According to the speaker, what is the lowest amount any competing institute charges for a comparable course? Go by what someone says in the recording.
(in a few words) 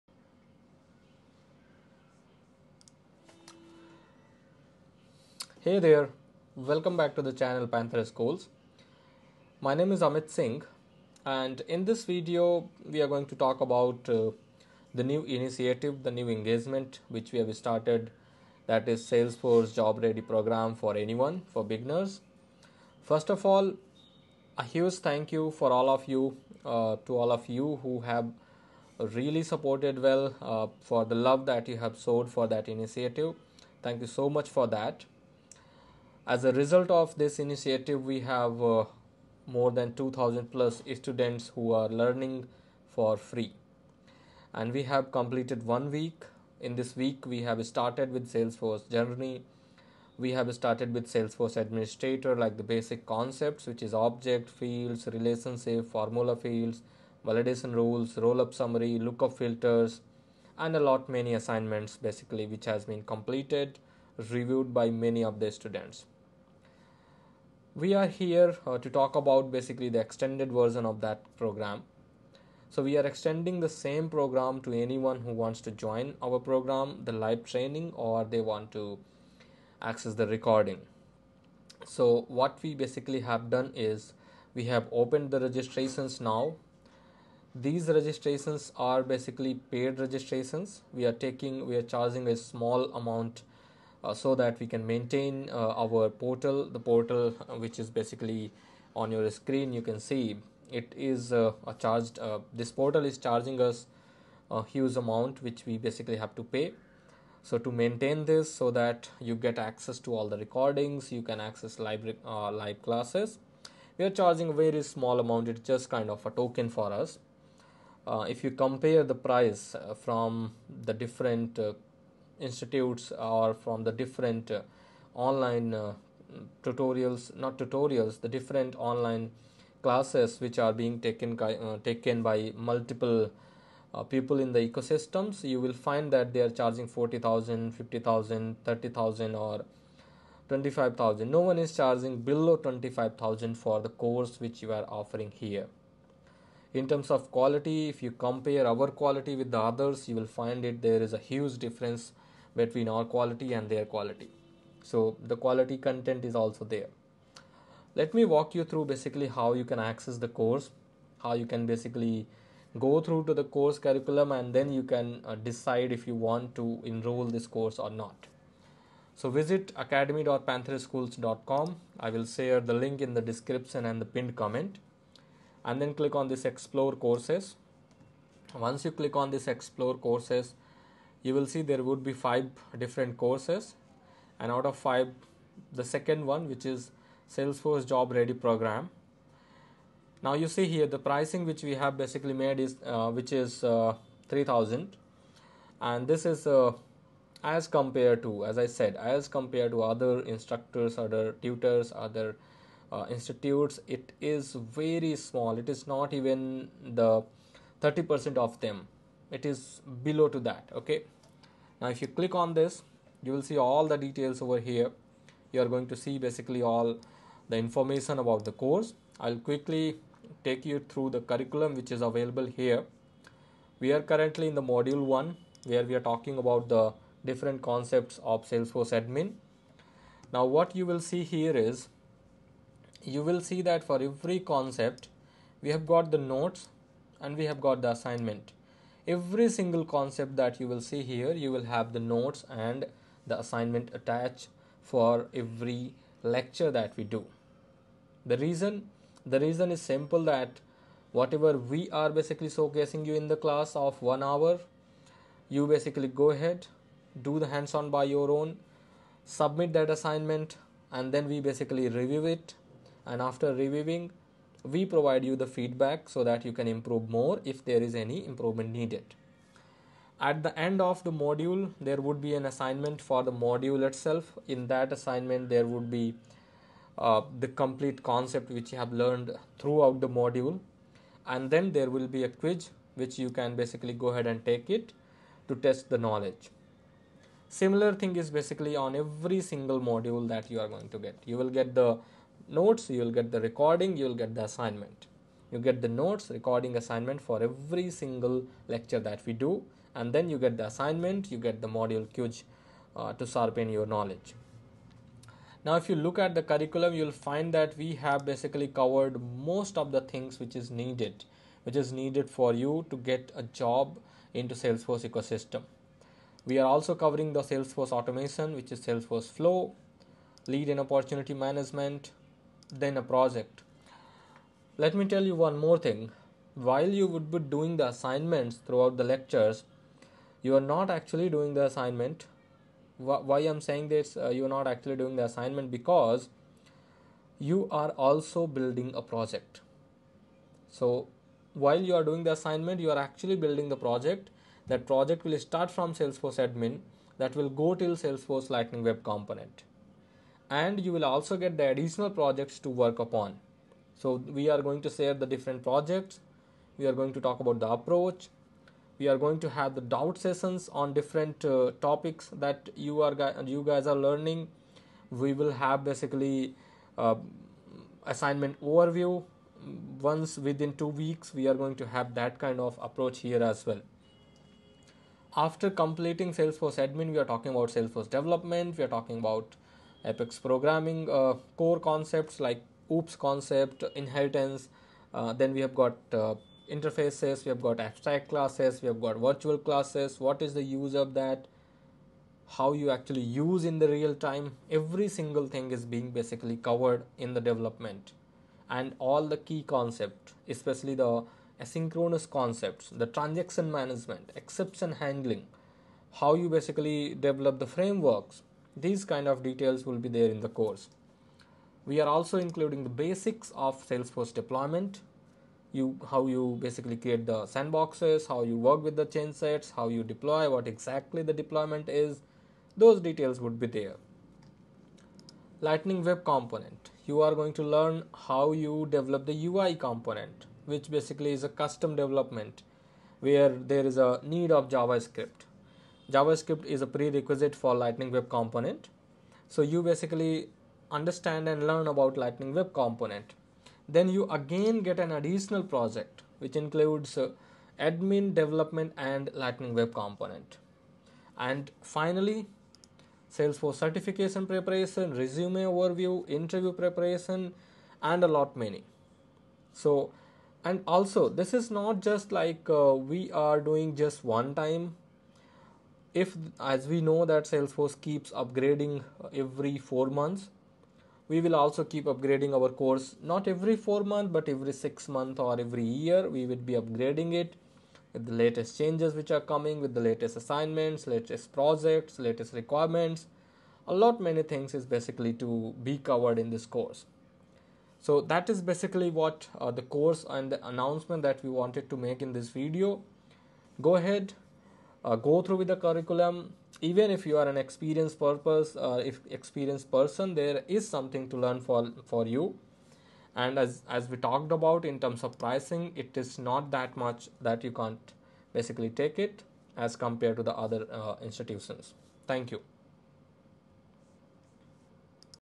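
25000.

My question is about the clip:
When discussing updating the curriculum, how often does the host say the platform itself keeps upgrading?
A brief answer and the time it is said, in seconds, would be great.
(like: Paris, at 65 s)
every 4 months, at 469 s.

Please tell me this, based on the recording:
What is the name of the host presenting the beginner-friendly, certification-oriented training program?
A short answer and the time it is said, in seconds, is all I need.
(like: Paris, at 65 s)
Amit Singh, at 10 s.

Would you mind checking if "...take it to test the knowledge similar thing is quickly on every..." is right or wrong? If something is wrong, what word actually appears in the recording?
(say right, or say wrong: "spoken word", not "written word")
wrong: "basically", not "quickly".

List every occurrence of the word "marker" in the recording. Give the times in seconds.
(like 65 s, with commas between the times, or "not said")
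not said.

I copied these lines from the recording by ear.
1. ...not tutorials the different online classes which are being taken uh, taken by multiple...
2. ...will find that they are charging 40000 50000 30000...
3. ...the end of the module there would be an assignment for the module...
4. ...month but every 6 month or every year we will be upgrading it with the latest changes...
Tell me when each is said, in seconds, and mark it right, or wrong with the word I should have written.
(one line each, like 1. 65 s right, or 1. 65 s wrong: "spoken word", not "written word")
1. 127 s right
2. 135 s right
3. 270 s right
4. 474 s right.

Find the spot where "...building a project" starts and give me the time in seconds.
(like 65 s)
338 s.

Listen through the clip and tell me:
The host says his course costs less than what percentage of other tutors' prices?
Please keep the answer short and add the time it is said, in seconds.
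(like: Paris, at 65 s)
30%, at 207 s.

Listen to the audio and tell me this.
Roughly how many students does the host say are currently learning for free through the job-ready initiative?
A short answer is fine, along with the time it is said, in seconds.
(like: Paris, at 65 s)
2000 plus, at 39 s.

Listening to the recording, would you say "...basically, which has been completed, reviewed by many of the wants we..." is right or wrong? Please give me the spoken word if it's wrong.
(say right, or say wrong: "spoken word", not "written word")
wrong: "students", not "wants".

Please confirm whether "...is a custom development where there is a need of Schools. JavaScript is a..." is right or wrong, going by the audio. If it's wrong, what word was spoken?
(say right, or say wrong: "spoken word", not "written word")
wrong: "JavaScript", not "Schools".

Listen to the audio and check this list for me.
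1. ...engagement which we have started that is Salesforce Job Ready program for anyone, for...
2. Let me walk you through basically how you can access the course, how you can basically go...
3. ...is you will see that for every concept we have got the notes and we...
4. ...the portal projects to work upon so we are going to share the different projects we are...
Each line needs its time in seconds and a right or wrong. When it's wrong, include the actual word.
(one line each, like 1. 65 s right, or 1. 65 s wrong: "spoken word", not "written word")
1. 16 s right
2. 157 s right
3. 231 s right
4. 351 s wrong: "additional", not "portal".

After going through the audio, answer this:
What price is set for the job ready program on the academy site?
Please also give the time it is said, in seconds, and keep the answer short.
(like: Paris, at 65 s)
3000, at 194 s.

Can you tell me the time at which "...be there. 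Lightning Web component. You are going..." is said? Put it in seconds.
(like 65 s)
423 s.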